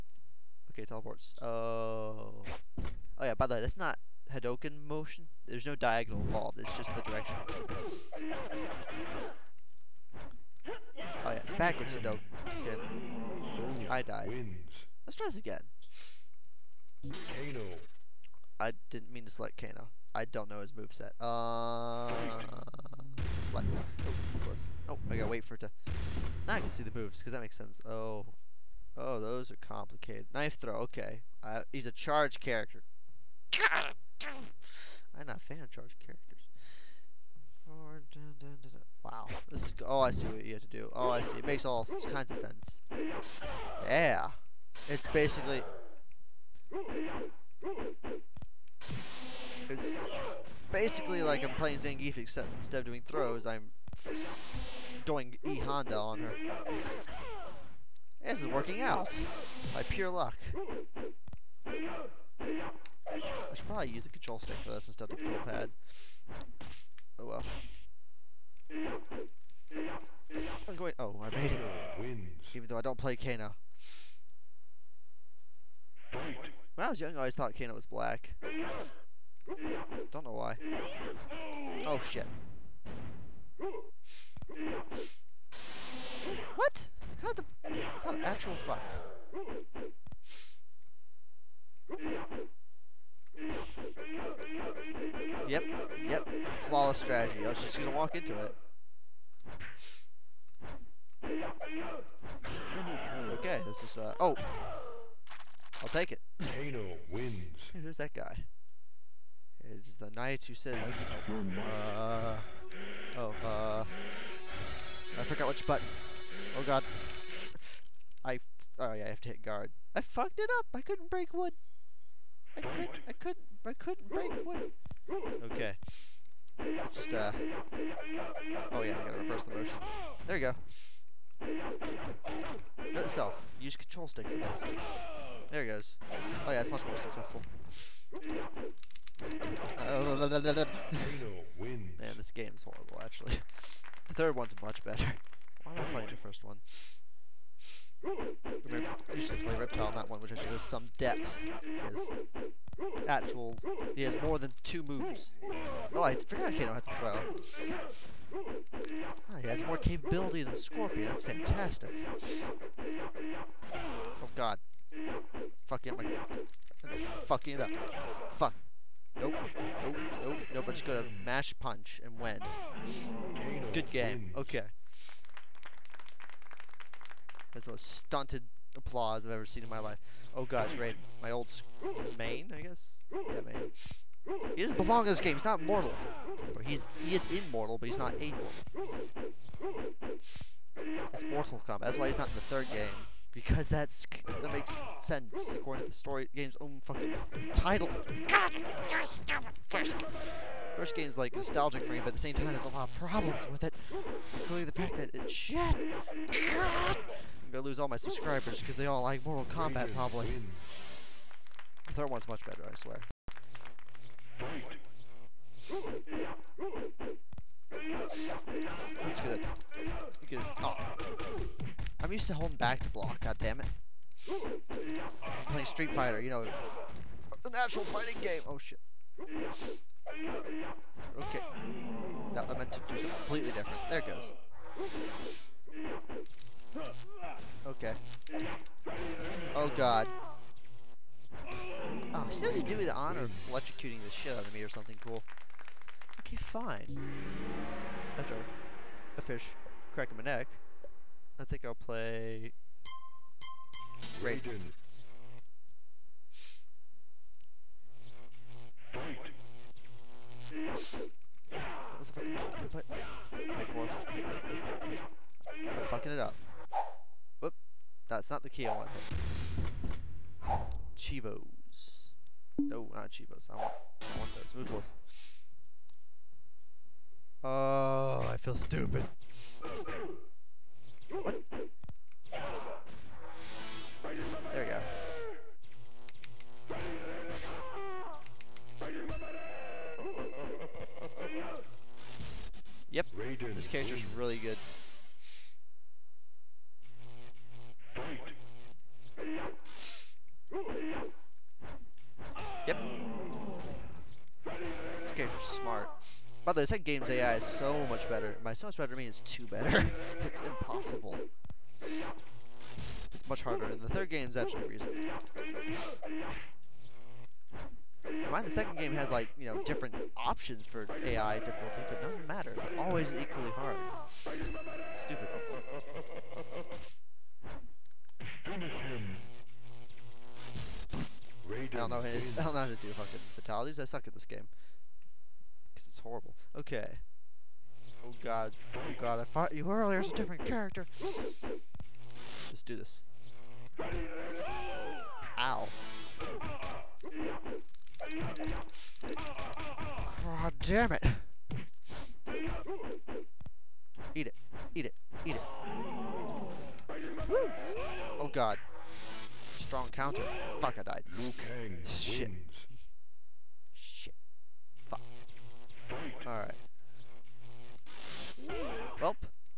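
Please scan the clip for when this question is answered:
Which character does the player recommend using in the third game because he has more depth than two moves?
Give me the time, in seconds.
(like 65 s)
149 s.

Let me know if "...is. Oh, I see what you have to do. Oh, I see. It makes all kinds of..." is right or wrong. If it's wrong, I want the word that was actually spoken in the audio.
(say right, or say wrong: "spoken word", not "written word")
right.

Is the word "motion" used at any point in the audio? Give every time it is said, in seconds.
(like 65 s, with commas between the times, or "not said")
4 s, 129 s.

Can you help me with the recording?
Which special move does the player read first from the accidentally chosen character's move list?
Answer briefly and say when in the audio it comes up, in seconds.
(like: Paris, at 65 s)
Knife throw, at 30 s.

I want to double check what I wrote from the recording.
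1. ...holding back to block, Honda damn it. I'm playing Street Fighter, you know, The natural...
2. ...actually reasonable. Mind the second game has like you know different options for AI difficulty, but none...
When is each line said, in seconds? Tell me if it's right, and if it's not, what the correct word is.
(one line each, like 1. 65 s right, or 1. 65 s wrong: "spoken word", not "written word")
1. 222 s wrong: "God", not "Honda"
2. 314 s right.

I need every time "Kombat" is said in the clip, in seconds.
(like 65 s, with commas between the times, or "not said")
191 s, 209 s.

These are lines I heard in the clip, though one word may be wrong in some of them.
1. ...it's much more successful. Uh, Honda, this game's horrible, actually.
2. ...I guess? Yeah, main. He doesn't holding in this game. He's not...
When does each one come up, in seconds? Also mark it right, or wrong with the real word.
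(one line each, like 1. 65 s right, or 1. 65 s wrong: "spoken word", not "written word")
1. 136 s wrong: "Man", not "Honda"
2. 182 s wrong: "belong", not "holding".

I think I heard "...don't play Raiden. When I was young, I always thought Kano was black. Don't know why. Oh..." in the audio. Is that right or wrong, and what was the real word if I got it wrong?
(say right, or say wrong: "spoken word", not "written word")
wrong: "Kano", not "Raiden".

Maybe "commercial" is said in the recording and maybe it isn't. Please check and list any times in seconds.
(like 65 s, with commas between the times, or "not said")
not said.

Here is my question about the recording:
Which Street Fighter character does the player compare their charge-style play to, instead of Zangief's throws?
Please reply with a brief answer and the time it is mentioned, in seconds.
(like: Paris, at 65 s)
E Honda, at 55 s.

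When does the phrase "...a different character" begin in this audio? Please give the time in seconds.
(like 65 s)
340 s.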